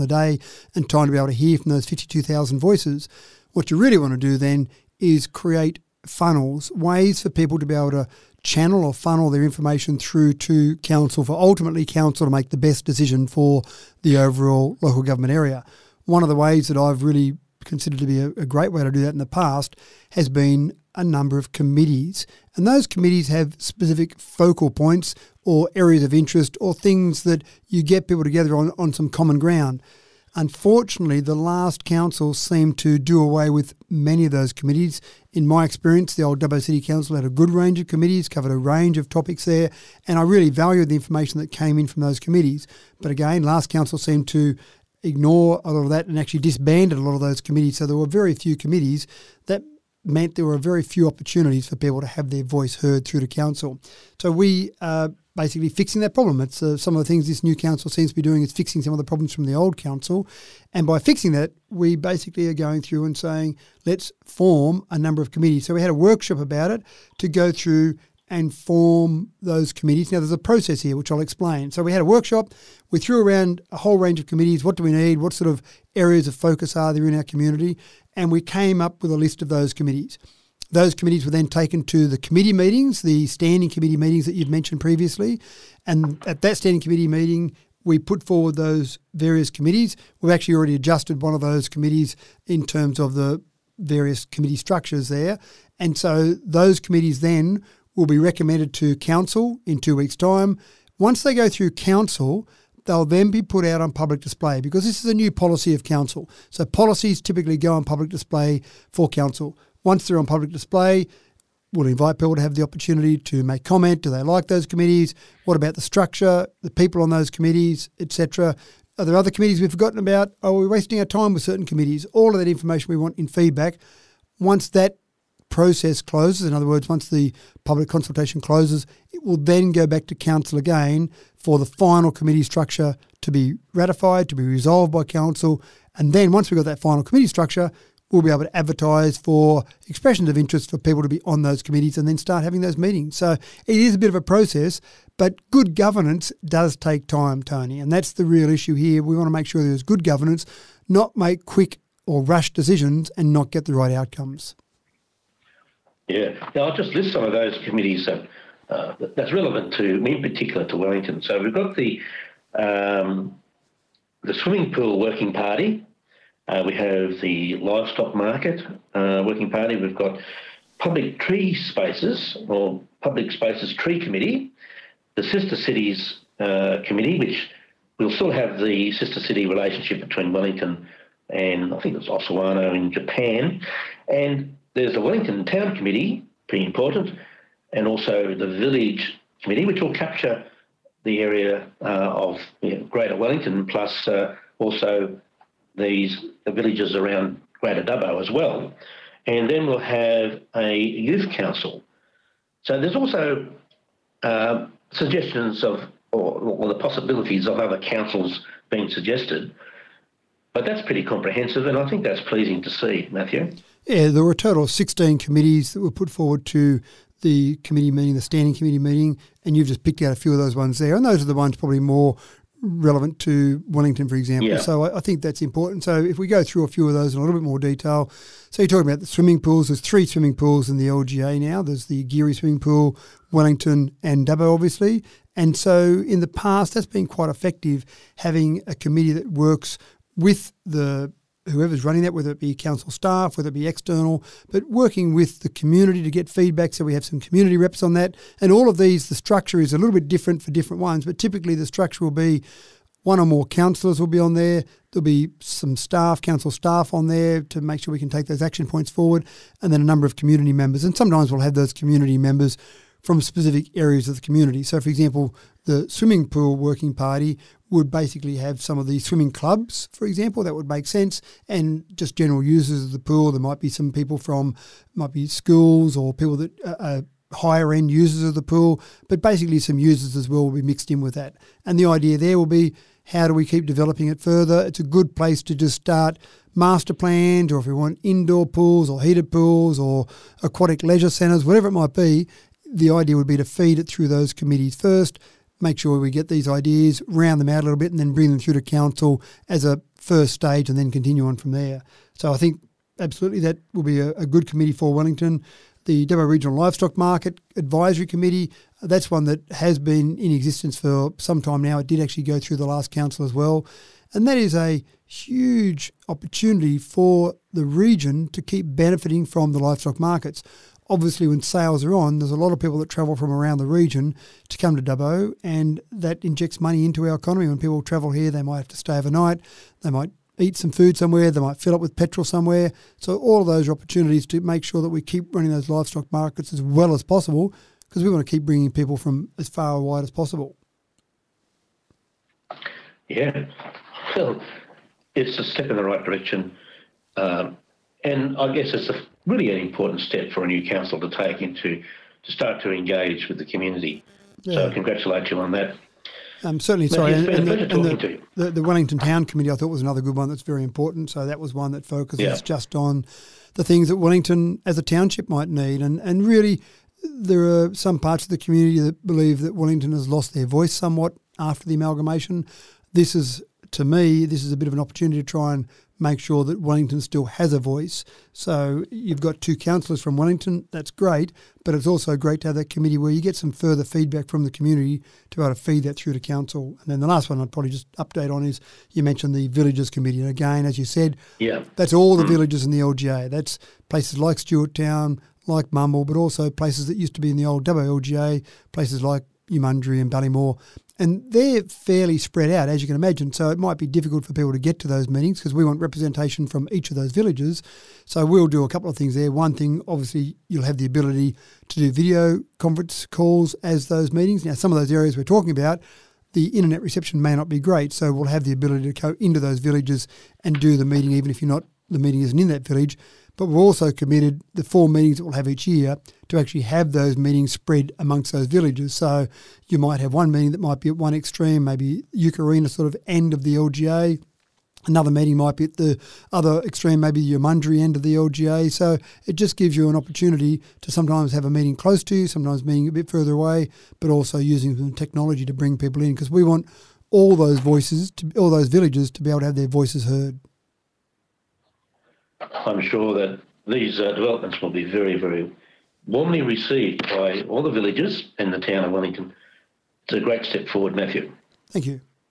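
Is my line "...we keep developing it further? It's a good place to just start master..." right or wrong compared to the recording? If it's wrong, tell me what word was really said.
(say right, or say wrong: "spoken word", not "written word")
right.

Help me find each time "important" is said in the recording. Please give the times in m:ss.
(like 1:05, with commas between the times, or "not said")
3:06, 3:45, 5:49, 6:00.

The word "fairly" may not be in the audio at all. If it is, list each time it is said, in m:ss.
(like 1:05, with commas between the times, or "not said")
6:41.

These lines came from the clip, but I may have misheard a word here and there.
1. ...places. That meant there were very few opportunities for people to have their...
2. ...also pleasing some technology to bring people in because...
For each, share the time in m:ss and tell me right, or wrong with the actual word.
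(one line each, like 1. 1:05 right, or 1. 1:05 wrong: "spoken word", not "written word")
1. 0:48 wrong: "committees", not "places"
2. 7:24 wrong: "using", not "pleasing".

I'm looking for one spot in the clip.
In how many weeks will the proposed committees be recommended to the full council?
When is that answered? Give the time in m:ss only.
1:39.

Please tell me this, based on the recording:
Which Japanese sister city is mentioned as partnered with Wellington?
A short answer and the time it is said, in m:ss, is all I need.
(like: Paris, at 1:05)
Osawano, at 3:02.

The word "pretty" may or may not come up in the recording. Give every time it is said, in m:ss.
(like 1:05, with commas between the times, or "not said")
3:06, 3:30.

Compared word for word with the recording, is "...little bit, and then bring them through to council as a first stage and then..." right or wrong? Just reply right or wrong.
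right.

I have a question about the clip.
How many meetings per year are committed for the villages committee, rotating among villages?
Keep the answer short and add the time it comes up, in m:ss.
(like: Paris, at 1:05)
4, at 7:04.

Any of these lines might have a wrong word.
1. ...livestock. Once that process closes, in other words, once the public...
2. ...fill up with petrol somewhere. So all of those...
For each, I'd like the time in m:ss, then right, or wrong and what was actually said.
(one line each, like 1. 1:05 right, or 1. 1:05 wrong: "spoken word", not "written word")
1. 2:03 wrong: "feedback", not "livestock"
2. 5:31 right.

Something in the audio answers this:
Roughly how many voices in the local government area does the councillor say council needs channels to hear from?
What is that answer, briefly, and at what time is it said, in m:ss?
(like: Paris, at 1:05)
52,000, at 0:01.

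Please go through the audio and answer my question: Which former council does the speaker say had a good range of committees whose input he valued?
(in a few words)
Dubbo City Council.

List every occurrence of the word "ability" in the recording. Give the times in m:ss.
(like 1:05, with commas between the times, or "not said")
6:50, 6:58.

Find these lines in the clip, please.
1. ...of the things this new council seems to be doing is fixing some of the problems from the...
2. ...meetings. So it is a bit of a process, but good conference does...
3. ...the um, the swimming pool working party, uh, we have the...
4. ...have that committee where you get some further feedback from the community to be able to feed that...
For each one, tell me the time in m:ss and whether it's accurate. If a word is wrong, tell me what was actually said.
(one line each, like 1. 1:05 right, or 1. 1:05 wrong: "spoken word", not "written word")
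1. 0:56 right
2. 2:22 wrong: "governance", not "conference"
3. 2:41 right
4. 6:22 right.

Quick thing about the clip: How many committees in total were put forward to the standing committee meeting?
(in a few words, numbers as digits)
16.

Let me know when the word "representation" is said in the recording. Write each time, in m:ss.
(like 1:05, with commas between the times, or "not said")
6:45.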